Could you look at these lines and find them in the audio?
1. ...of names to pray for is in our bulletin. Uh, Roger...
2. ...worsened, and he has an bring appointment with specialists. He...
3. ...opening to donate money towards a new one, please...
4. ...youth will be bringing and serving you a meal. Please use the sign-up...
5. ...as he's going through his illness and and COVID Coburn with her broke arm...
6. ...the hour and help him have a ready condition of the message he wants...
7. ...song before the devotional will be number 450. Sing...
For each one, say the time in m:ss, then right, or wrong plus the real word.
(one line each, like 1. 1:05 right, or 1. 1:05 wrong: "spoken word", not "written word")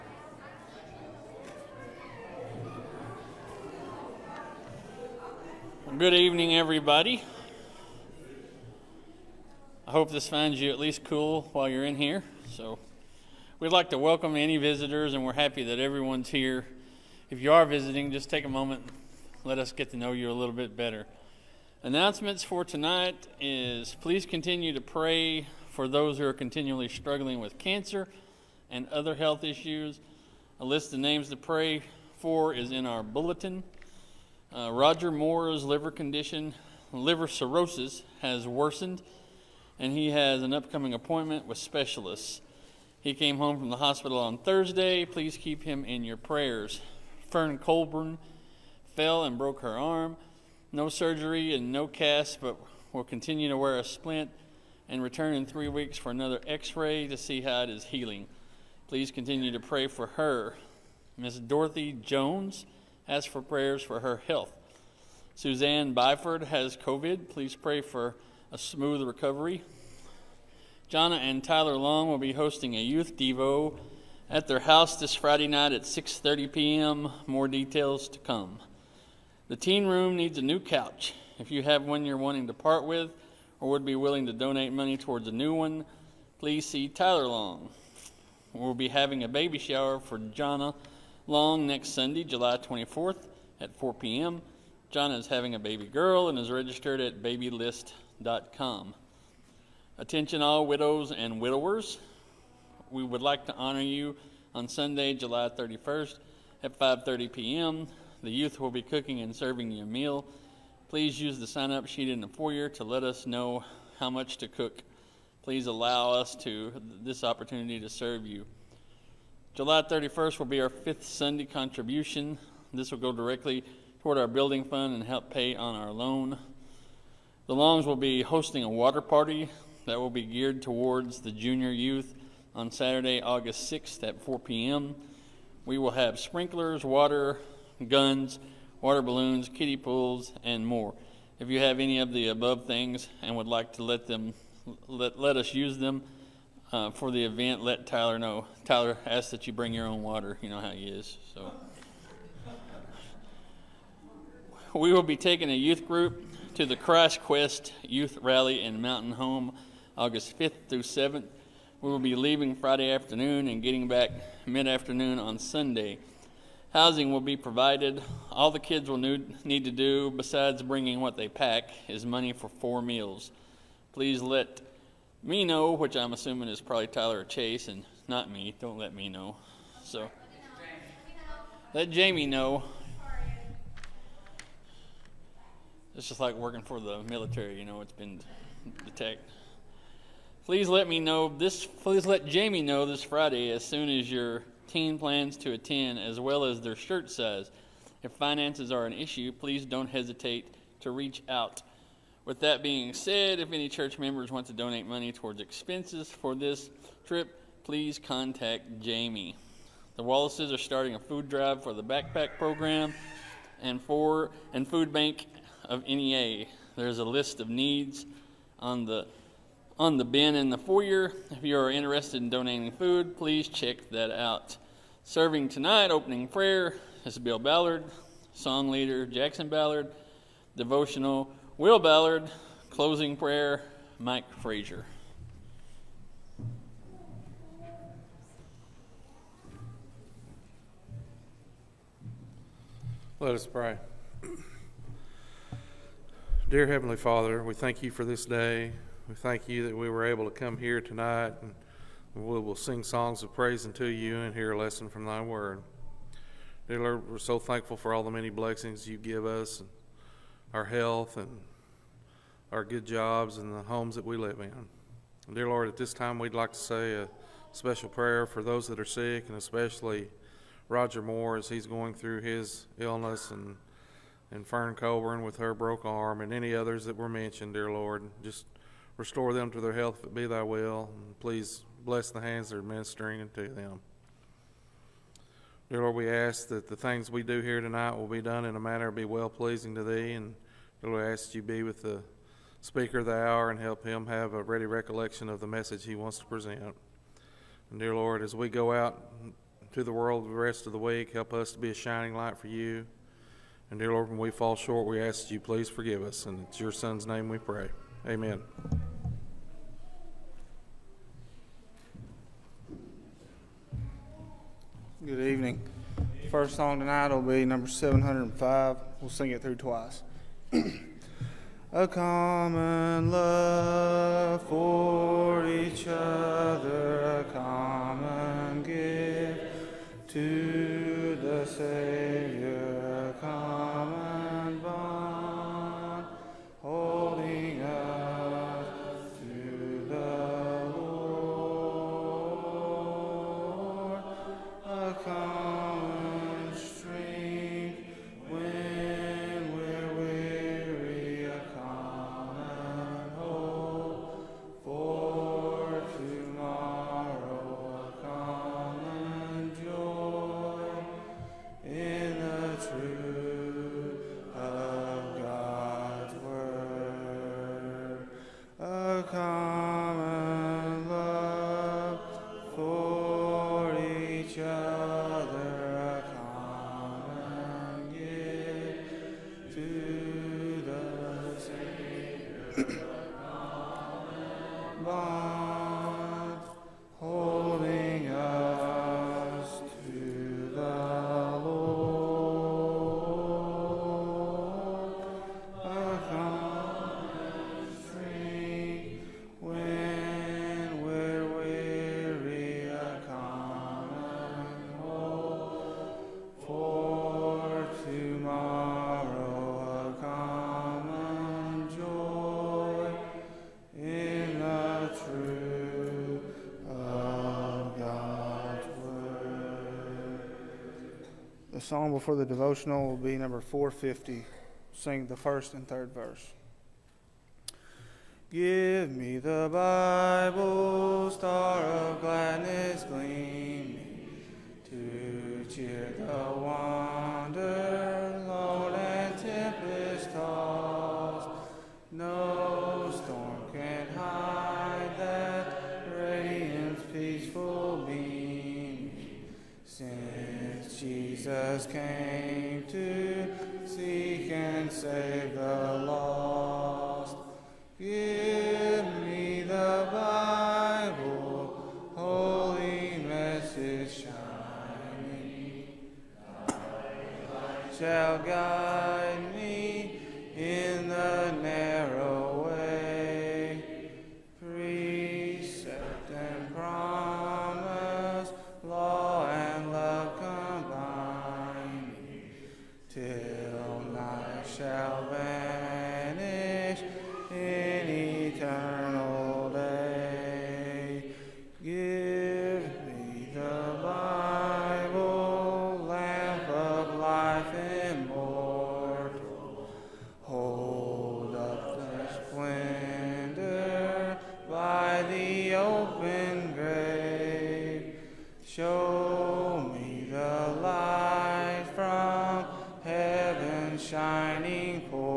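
1. 0:30 right
2. 0:38 wrong: "upcoming", not "bring"
3. 1:23 wrong: "willing", not "opening"
4. 1:48 wrong: "cooking", not "bringing"
5. 4:31 wrong: "Fern", not "COVID"
6. 4:53 wrong: "recollection", not "condition"
7. 7:01 right.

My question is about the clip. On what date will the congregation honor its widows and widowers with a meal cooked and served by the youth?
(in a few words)
July 31st.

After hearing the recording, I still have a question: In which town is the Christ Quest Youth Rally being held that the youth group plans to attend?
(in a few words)
Mountain Home.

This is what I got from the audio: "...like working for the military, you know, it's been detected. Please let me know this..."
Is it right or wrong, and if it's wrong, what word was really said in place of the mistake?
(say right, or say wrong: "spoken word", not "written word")
right.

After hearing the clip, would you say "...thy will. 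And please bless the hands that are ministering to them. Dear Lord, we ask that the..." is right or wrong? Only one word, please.
right.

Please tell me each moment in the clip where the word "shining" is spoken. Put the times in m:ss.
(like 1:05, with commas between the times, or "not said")
5:01, 7:44.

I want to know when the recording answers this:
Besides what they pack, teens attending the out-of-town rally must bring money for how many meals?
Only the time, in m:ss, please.
2:52.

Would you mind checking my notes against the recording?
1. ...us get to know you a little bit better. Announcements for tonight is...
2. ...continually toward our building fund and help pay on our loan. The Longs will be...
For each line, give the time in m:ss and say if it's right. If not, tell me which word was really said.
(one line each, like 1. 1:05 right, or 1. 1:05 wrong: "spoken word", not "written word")
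1. 0:19 right
2. 2:03 wrong: "directly", not "continually".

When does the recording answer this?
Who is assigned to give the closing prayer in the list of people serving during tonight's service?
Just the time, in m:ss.
3:53.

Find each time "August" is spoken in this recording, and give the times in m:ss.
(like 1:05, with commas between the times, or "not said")
2:13, 2:39.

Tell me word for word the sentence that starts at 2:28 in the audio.
Tyler asks that you bring your own water.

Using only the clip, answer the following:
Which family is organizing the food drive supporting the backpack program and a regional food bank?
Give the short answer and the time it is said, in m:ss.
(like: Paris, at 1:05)
The Wallaces, at 3:29.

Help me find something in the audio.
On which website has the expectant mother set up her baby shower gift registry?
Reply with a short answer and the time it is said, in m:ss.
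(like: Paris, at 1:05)
babylist.com, at 1:37.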